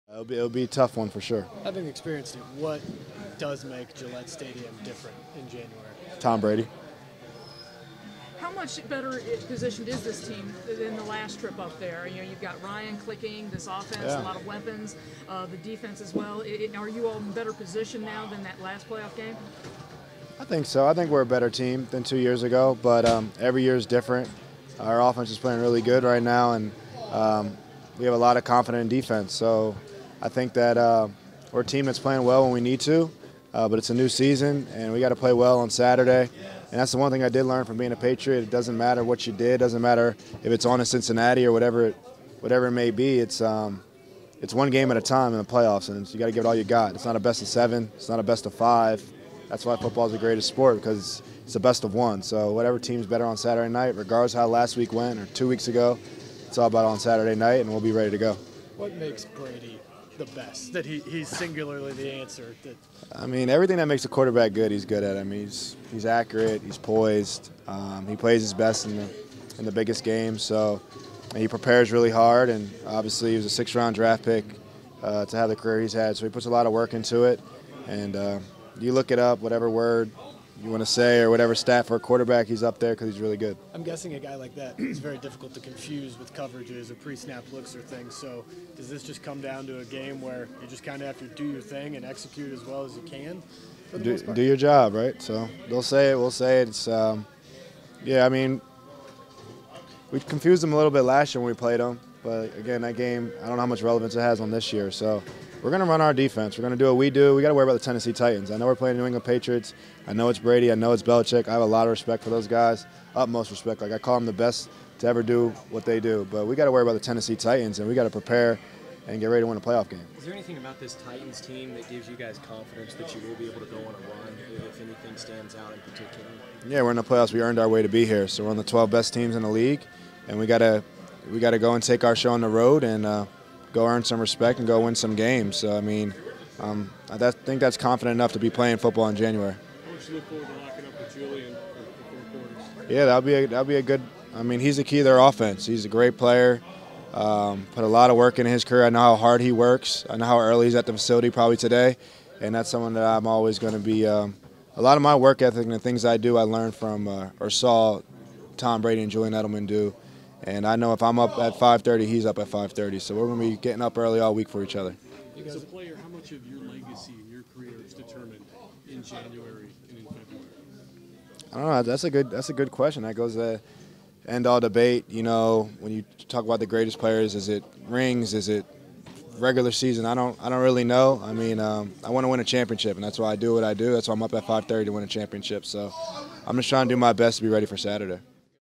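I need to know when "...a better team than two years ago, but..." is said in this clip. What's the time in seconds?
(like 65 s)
21 s.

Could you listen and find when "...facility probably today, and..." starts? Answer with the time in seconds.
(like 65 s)
150 s.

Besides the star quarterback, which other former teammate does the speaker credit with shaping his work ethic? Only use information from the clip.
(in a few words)
Julian Edelman.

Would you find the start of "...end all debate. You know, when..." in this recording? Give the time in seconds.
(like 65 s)
174 s.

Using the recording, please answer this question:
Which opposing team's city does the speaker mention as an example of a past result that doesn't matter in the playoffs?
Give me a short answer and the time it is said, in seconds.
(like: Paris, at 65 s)
Cincinnati, at 40 s.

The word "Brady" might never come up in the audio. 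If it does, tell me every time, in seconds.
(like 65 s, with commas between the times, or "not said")
6 s, 59 s, 110 s, 158 s.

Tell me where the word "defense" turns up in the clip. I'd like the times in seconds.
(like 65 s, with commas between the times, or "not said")
15 s, 28 s, 106 s.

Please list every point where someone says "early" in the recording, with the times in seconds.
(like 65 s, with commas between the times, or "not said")
150 s, 163 s.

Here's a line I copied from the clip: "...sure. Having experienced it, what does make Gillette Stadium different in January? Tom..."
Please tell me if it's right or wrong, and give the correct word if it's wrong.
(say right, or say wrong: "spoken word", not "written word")
right.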